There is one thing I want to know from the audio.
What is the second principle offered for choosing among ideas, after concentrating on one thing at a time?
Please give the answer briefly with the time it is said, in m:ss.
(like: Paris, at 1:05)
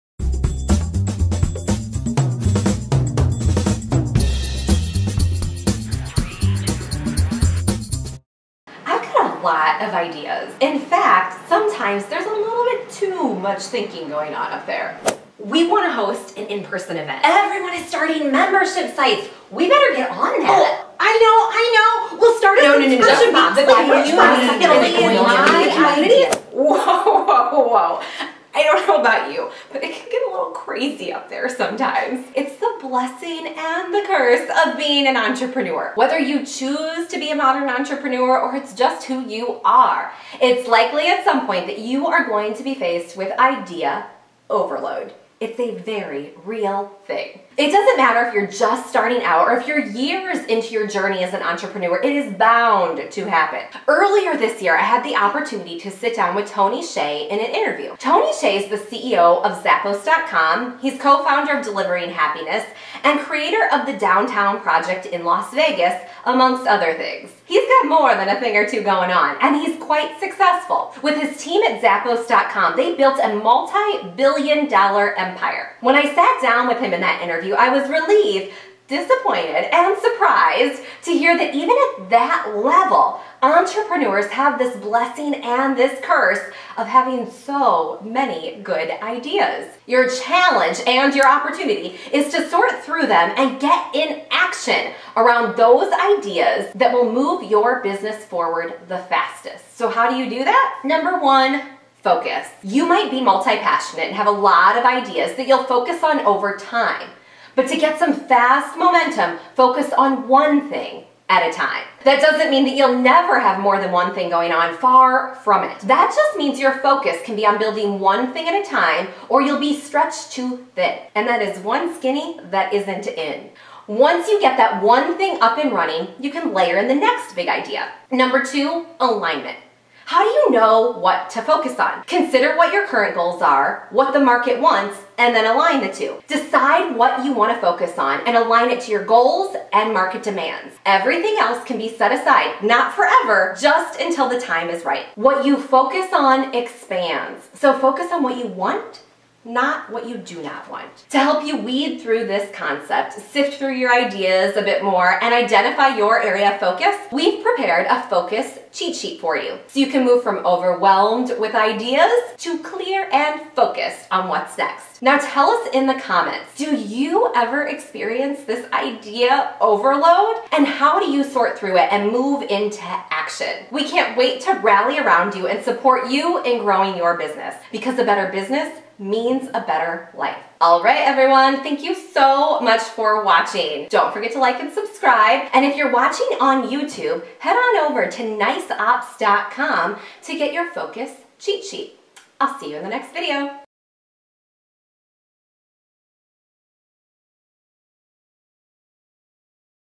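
Alignment, at 2:08.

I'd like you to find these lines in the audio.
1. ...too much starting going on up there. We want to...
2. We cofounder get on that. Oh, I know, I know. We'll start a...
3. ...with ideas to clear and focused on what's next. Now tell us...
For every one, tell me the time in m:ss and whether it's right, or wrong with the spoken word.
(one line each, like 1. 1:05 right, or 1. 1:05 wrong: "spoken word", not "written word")
1. 0:12 wrong: "thinking", not "starting"
2. 0:19 wrong: "better", not "cofounder"
3. 2:41 right.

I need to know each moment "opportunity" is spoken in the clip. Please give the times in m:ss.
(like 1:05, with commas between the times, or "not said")
0:55, 1:31.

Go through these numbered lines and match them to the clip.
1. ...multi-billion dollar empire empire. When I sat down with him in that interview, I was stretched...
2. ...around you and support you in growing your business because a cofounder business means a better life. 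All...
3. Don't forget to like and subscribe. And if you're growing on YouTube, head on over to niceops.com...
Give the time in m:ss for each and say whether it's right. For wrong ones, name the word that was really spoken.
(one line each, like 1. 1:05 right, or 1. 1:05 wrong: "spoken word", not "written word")
1. 1:13 wrong: "relieved", not "stretched"
2. 2:54 wrong: "better", not "cofounder"
3. 3:03 wrong: "watching", not "growing".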